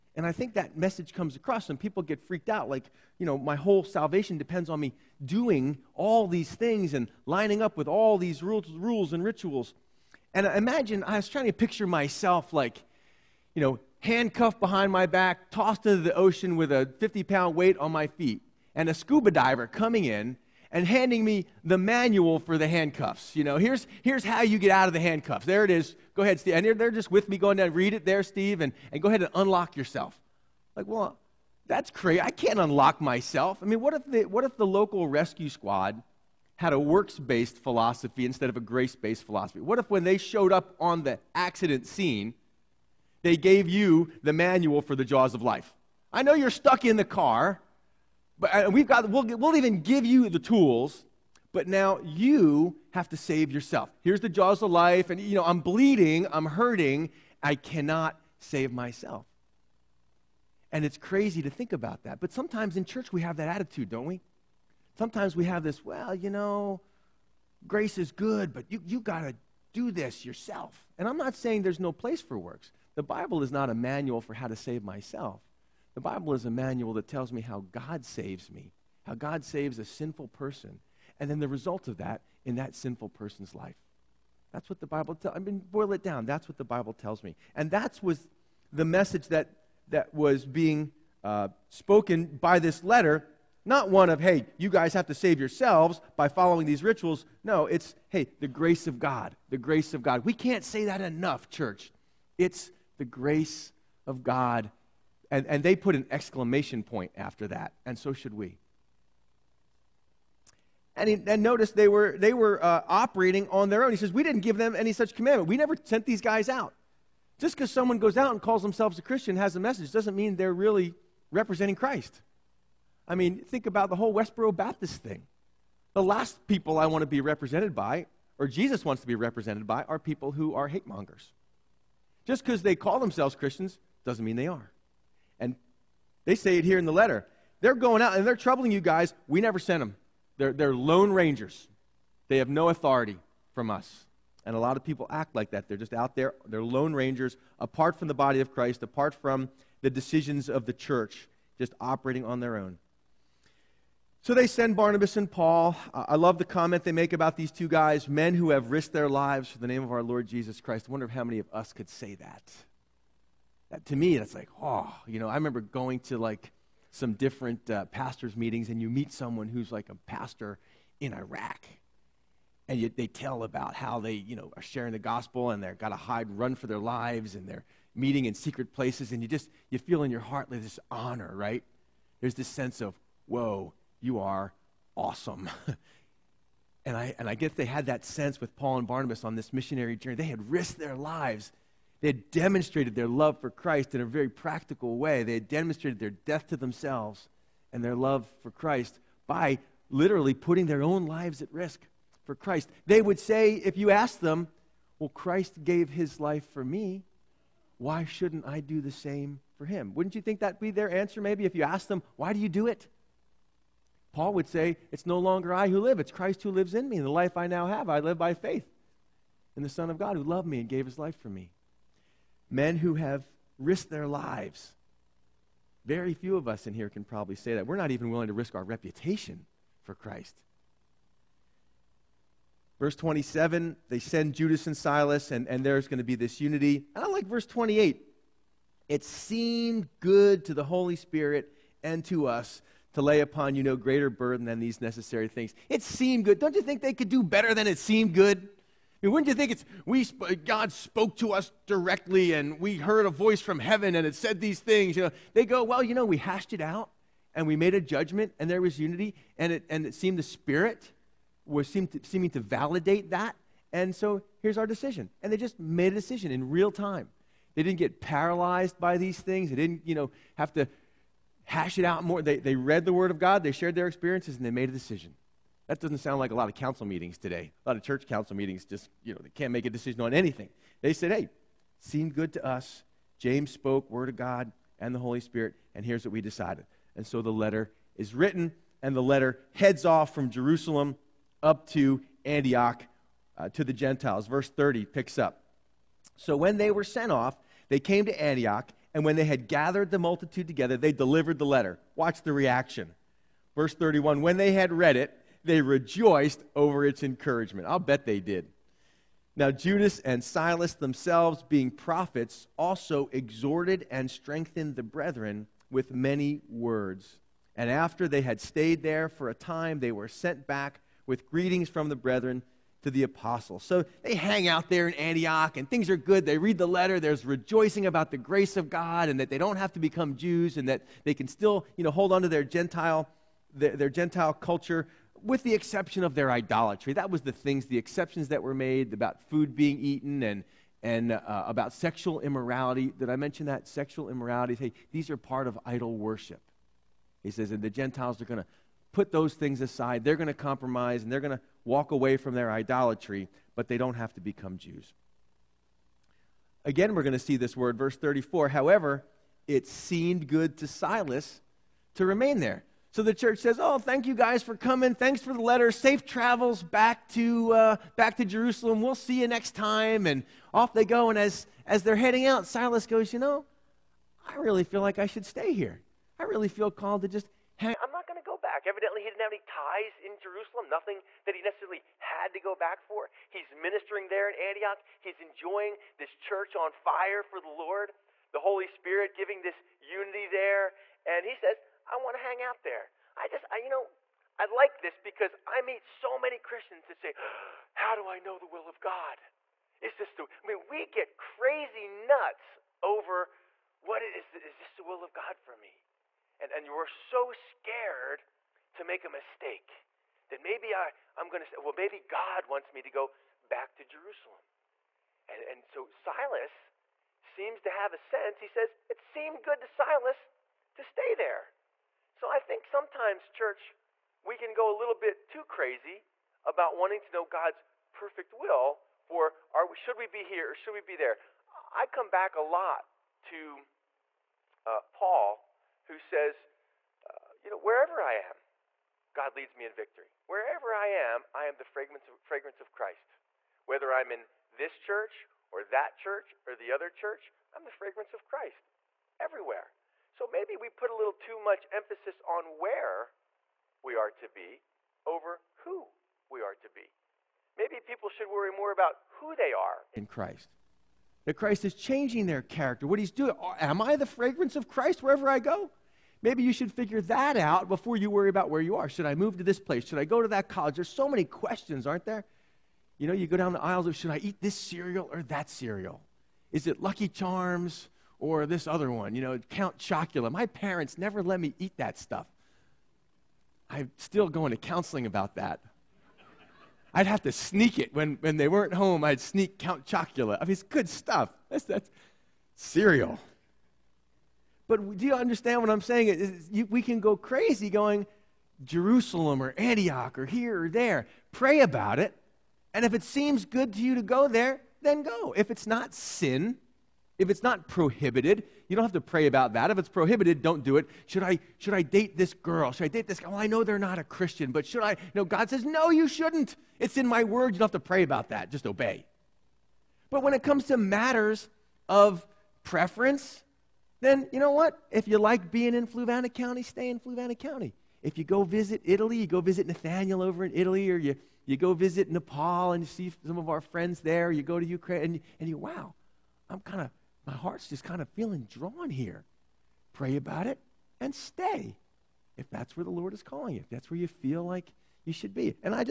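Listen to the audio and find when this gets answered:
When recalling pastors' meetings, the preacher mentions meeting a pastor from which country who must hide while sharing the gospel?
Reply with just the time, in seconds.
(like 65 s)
171 s.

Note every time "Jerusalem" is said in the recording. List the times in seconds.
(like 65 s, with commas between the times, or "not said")
290 s, 368 s, 380 s, 413 s, 498 s.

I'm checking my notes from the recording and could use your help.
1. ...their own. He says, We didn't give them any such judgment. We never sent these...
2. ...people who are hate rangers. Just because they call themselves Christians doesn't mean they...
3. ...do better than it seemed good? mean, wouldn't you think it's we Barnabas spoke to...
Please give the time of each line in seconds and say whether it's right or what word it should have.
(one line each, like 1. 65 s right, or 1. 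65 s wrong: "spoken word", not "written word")
1. 113 s wrong: "commandment", not "judgment"
2. 129 s wrong: "mongers", not "rangers"
3. 247 s wrong: "God", not "Barnabas".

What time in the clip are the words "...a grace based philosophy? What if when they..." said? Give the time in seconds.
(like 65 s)
38 s.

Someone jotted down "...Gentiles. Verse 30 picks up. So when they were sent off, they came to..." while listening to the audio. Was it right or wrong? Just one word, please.
right.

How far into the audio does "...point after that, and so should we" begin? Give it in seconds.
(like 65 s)
106 s.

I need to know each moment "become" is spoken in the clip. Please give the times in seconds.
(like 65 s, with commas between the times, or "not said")
329 s, 354 s.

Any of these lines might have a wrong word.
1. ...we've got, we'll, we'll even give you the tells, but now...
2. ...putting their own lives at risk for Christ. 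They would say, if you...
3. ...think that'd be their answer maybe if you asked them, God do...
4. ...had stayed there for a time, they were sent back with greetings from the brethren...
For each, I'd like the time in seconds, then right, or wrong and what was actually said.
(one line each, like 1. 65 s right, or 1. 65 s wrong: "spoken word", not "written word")
1. 48 s wrong: "tools", not "tells"
2. 200 s right
3. 210 s wrong: "Why", not "God"
4. 318 s right.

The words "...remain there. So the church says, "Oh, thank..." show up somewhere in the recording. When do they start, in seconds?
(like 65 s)
362 s.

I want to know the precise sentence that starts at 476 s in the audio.
Is it Lucky Charms or this other one, you know, Count Chocula.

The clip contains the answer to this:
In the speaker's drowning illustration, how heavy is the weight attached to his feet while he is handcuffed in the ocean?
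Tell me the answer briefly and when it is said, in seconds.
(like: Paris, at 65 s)
50 pounds, at 16 s.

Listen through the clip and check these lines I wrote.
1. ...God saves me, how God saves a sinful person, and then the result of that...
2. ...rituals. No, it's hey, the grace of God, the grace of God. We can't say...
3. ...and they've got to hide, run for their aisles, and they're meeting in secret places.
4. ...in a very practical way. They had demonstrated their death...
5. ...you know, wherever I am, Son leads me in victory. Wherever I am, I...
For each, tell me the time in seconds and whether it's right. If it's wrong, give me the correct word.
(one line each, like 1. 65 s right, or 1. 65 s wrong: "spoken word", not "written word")
1. 77 s right
2. 96 s right
3. 175 s wrong: "lives", not "aisles"
4. 193 s right
5. 437 s wrong: "God", not "Son".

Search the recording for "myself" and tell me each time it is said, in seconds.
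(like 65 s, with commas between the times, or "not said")
11 s, 32 s, 58 s, 74 s.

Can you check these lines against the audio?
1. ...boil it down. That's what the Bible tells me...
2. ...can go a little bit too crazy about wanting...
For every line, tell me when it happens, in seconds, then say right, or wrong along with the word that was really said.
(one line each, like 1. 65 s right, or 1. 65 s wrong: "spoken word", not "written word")
1. 85 s right
2. 424 s right.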